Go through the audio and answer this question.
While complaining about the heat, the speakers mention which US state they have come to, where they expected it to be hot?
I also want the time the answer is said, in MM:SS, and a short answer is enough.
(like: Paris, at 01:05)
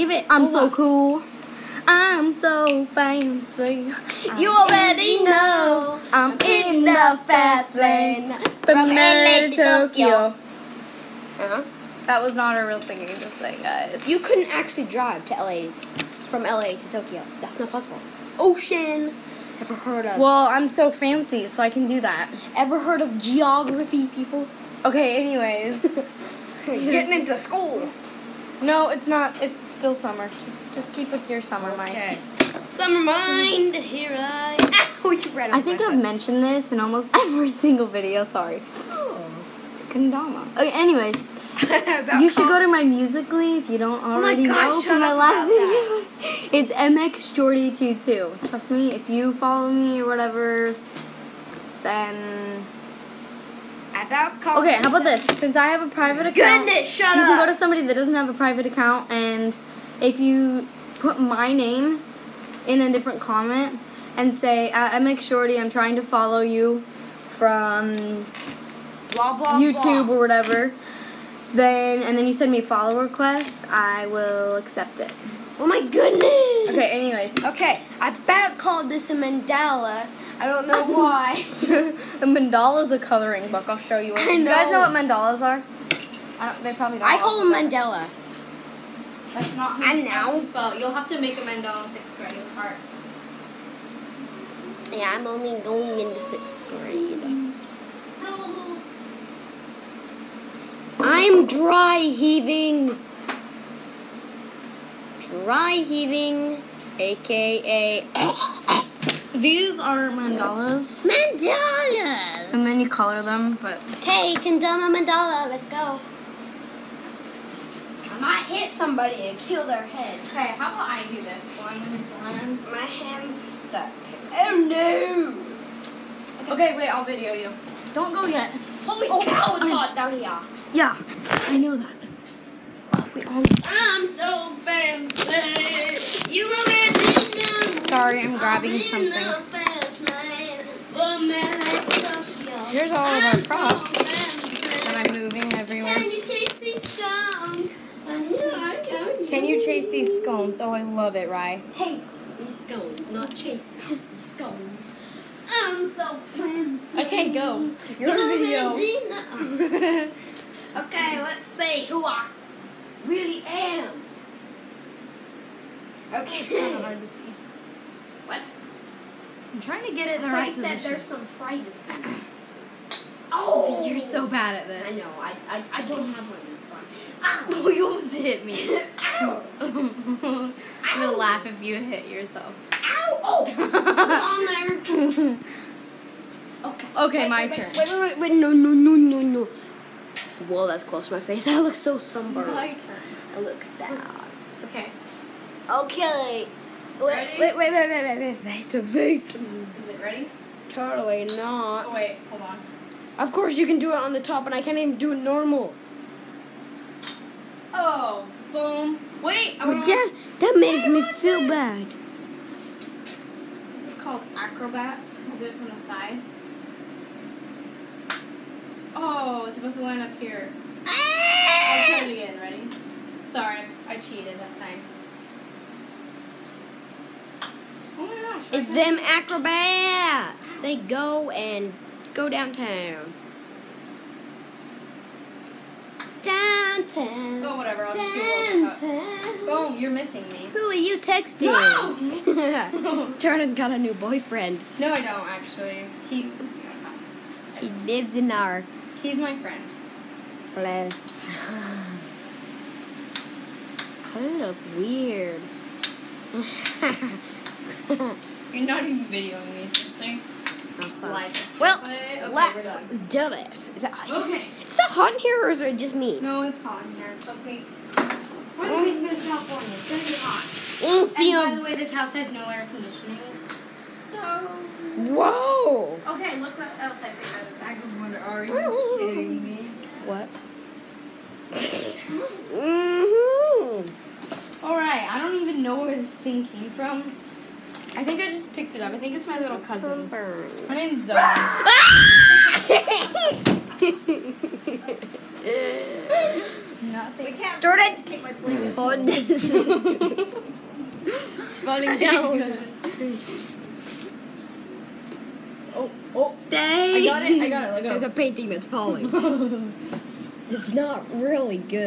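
California, at 04:29.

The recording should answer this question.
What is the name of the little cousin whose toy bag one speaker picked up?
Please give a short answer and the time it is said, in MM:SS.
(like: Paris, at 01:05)
Zoe, at 04:51.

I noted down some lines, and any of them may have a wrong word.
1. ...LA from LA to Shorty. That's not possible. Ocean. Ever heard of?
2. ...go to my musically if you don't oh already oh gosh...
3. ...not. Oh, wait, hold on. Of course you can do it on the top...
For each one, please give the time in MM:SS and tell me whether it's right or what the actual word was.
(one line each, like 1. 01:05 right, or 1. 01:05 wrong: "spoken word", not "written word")
1. 00:15 wrong: "Tokyo", not "Shorty"
2. 00:42 right
3. 03:21 right.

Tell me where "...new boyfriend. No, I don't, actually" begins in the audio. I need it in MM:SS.
04:03.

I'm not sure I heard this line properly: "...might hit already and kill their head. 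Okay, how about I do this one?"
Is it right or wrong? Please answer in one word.
wrong.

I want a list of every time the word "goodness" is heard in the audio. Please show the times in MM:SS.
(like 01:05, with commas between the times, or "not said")
00:56, 01:15.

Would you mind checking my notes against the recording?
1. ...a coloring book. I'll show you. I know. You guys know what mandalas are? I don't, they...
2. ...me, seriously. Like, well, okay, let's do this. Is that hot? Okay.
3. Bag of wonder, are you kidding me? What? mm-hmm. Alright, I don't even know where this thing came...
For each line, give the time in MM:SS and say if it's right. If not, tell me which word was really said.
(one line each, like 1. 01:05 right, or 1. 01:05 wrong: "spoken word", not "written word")
1. 01:22 right
2. 04:19 right
3. 04:37 right.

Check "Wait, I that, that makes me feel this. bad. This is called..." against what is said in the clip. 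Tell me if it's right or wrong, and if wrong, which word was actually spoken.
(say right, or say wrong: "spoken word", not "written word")
right.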